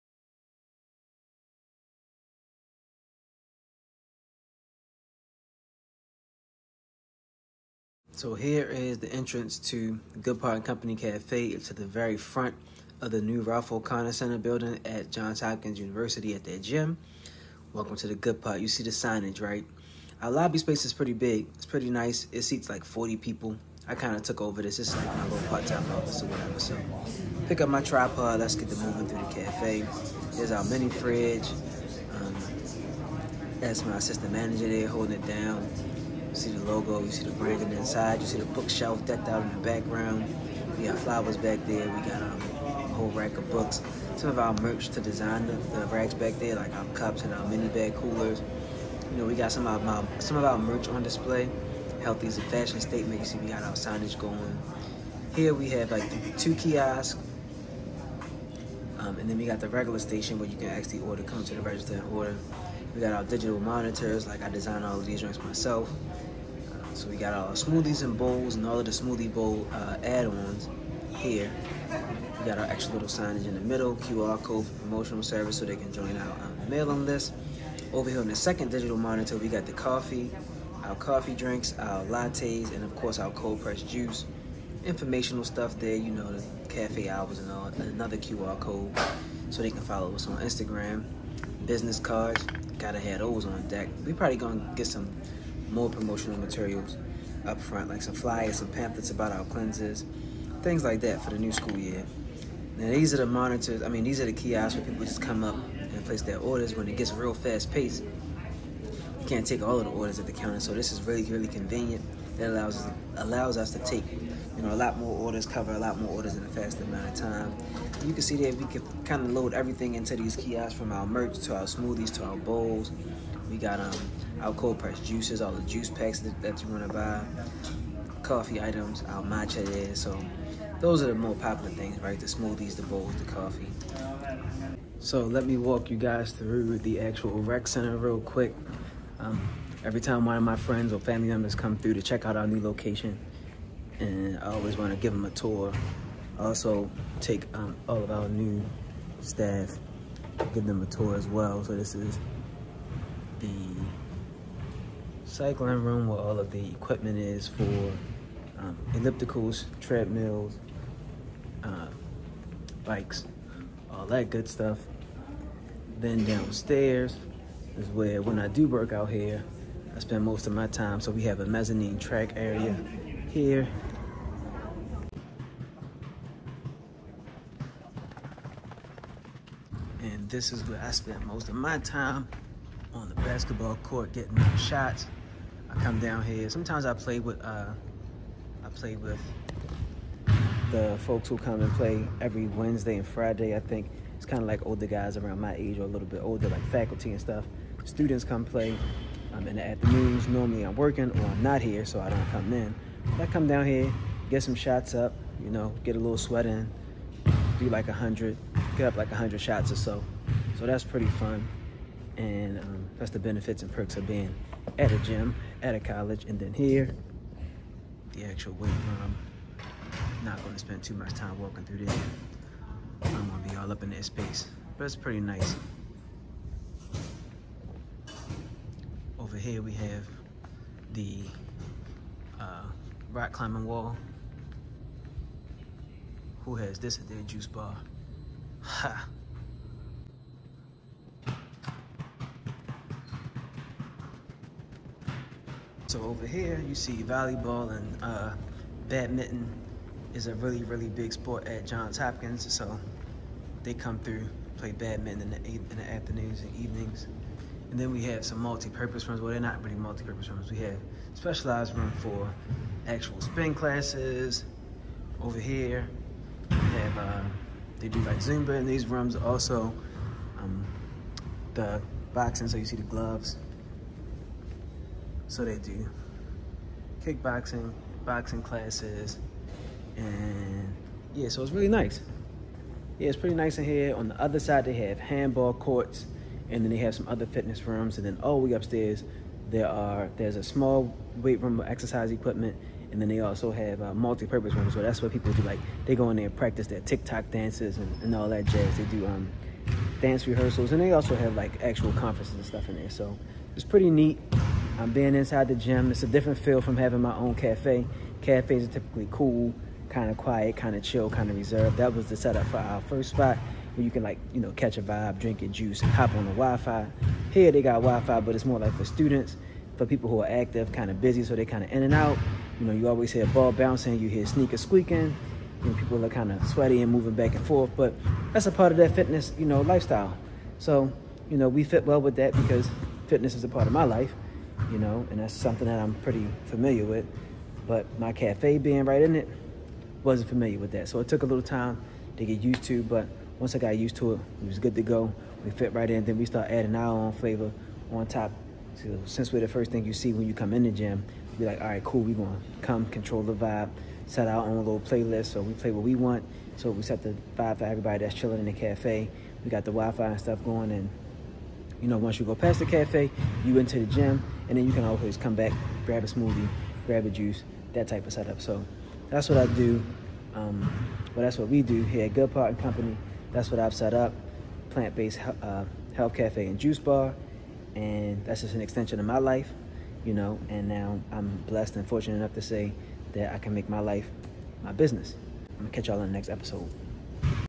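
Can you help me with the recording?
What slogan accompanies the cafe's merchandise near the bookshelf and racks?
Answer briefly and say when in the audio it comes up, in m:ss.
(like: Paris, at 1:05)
Healthy is a fashion statement, at 0:52.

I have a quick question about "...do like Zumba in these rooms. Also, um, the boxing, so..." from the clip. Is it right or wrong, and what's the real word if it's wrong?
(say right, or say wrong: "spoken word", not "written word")
right.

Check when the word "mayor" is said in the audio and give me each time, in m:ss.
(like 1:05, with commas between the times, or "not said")
not said.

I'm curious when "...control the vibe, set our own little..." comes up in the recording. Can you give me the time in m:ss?
5:52.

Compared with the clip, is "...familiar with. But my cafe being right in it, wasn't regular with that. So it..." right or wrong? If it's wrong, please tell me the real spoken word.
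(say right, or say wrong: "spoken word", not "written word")
wrong: "familiar", not "regular".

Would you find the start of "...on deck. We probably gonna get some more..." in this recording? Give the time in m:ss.
1:33.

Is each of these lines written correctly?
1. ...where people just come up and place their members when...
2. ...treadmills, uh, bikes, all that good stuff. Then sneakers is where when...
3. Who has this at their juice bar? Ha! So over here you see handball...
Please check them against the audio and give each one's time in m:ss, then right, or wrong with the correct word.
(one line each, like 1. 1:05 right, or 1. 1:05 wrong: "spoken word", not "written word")
1. 1:44 wrong: "orders", not "members"
2. 2:39 wrong: "downstairs", not "sneakers"
3. 3:56 wrong: "volleyball", not "handball".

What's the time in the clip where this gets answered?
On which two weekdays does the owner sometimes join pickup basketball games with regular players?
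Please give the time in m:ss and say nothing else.
3:12.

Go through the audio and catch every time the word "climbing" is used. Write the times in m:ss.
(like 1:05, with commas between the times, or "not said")
3:53.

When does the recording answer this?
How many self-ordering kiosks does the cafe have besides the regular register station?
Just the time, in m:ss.
0:56.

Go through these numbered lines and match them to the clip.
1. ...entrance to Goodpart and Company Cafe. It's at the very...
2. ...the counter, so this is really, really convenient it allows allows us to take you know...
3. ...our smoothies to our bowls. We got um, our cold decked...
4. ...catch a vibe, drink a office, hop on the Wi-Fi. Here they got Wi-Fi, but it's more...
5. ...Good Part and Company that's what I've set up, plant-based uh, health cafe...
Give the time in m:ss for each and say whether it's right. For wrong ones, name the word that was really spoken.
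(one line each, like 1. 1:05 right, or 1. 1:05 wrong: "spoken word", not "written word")
1. 0:09 right
2. 1:50 right
3. 2:01 wrong: "pressed", not "decked"
4. 5:14 wrong: "juice", not "office"
5. 6:12 right.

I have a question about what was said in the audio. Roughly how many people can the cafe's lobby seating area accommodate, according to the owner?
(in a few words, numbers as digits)
40.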